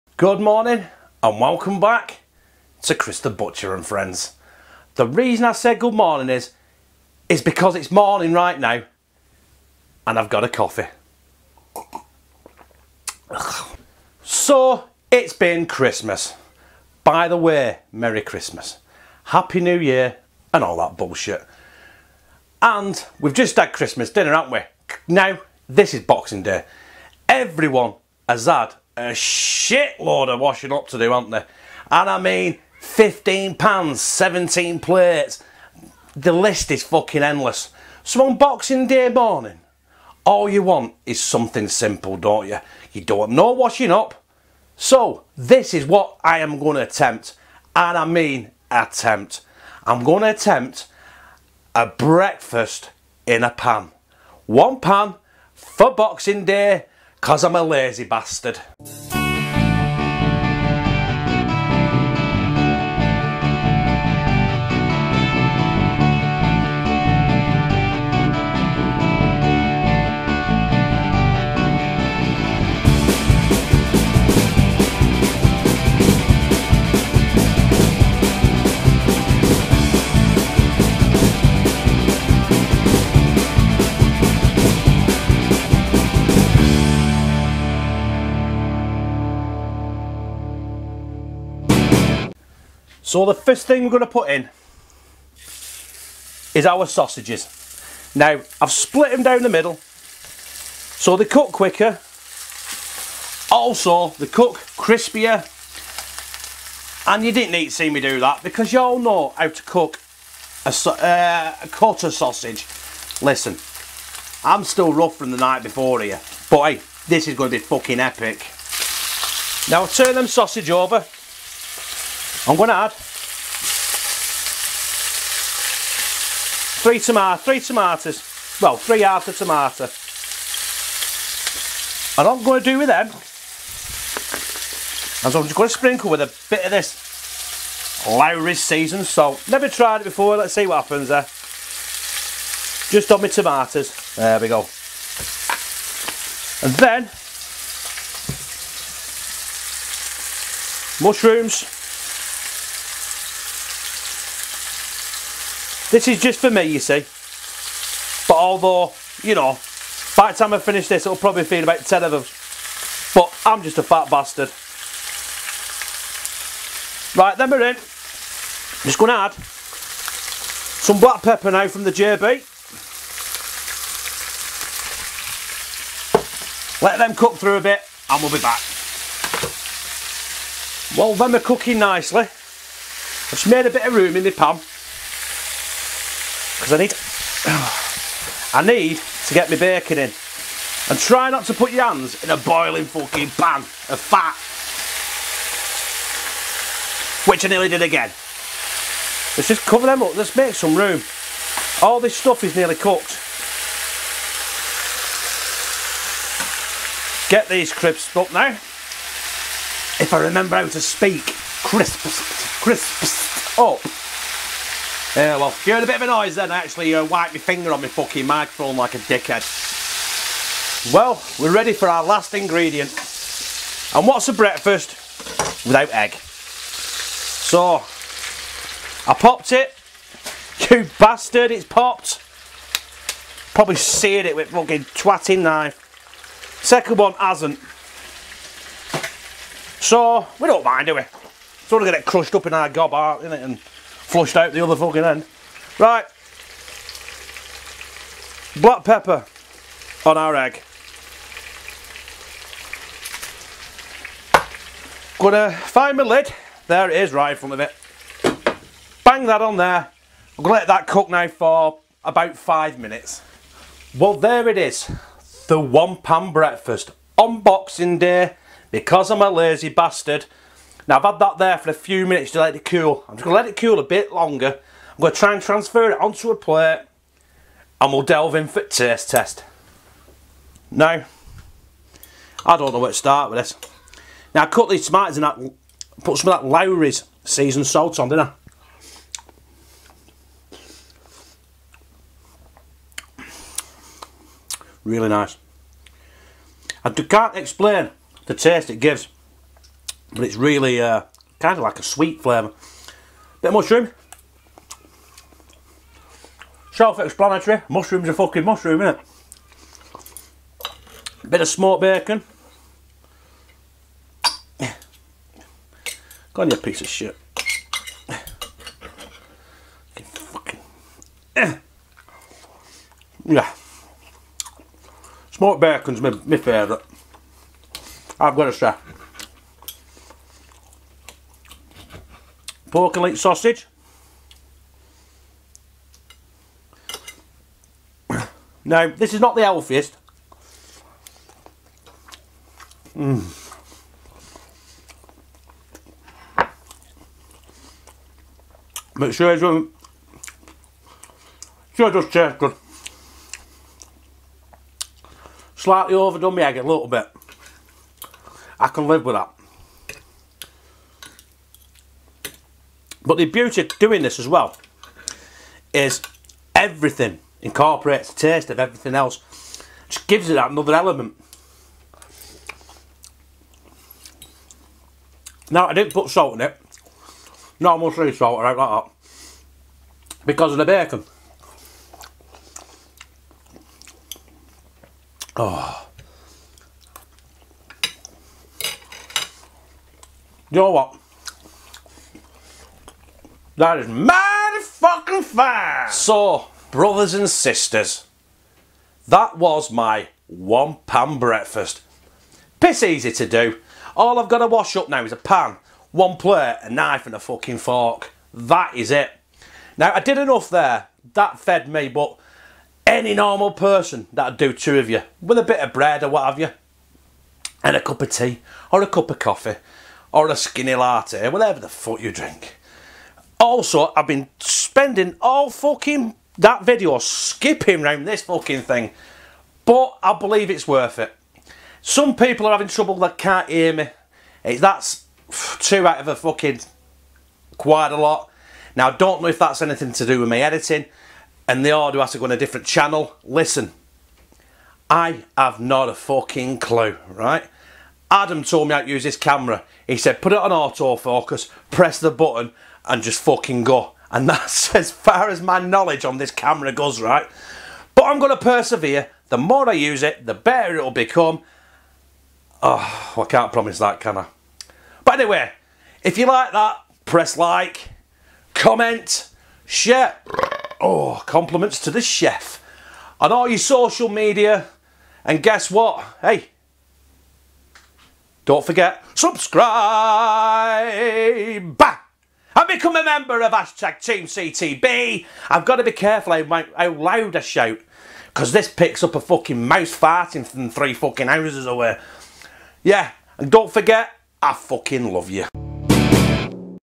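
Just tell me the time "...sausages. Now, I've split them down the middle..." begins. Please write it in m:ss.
1:36.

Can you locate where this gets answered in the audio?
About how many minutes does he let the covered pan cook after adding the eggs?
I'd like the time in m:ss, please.
4:22.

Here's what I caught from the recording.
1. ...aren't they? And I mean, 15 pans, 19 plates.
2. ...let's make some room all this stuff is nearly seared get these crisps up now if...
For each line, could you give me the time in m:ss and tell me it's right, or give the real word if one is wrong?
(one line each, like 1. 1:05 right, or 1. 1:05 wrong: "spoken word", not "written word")
1. 0:31 wrong: "17", not "19"
2. 3:20 wrong: "cooked", not "seared".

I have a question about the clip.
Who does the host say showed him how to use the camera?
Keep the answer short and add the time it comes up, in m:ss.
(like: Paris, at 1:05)
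Adam, at 7:28.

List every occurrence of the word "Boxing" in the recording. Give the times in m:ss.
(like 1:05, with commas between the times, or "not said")
0:26, 0:38, 0:55, 4:27.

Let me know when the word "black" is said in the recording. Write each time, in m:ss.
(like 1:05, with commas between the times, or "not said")
2:51, 4:08.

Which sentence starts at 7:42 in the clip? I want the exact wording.
Oh, I can't promise that, can I?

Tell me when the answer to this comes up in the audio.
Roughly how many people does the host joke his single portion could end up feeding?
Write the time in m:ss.
2:41.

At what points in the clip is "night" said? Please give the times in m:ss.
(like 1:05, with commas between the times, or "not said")
1:55.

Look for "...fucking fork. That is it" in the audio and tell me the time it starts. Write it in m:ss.
6:47.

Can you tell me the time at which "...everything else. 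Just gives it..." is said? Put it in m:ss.
6:08.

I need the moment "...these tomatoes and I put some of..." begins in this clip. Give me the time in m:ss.
4:44.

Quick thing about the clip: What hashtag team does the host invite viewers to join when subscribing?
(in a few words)
Team CTB.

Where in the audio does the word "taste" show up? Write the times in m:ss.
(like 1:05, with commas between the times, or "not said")
4:38, 4:58, 5:52, 6:08.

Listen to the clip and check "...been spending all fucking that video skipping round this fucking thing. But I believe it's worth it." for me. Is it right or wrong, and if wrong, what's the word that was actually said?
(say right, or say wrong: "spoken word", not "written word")
right.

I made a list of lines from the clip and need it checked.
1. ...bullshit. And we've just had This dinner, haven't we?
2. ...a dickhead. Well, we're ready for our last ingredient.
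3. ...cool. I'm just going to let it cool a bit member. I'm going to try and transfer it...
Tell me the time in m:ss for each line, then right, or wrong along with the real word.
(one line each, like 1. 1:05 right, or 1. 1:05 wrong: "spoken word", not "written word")
1. 0:20 wrong: "Christmas", not "This"
2. 3:38 right
3. 4:32 wrong: "longer", not "member".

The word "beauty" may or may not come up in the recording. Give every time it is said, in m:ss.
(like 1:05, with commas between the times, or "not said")
6:03.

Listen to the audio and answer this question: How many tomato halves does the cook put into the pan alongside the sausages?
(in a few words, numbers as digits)
3.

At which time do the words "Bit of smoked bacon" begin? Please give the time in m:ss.
5:11.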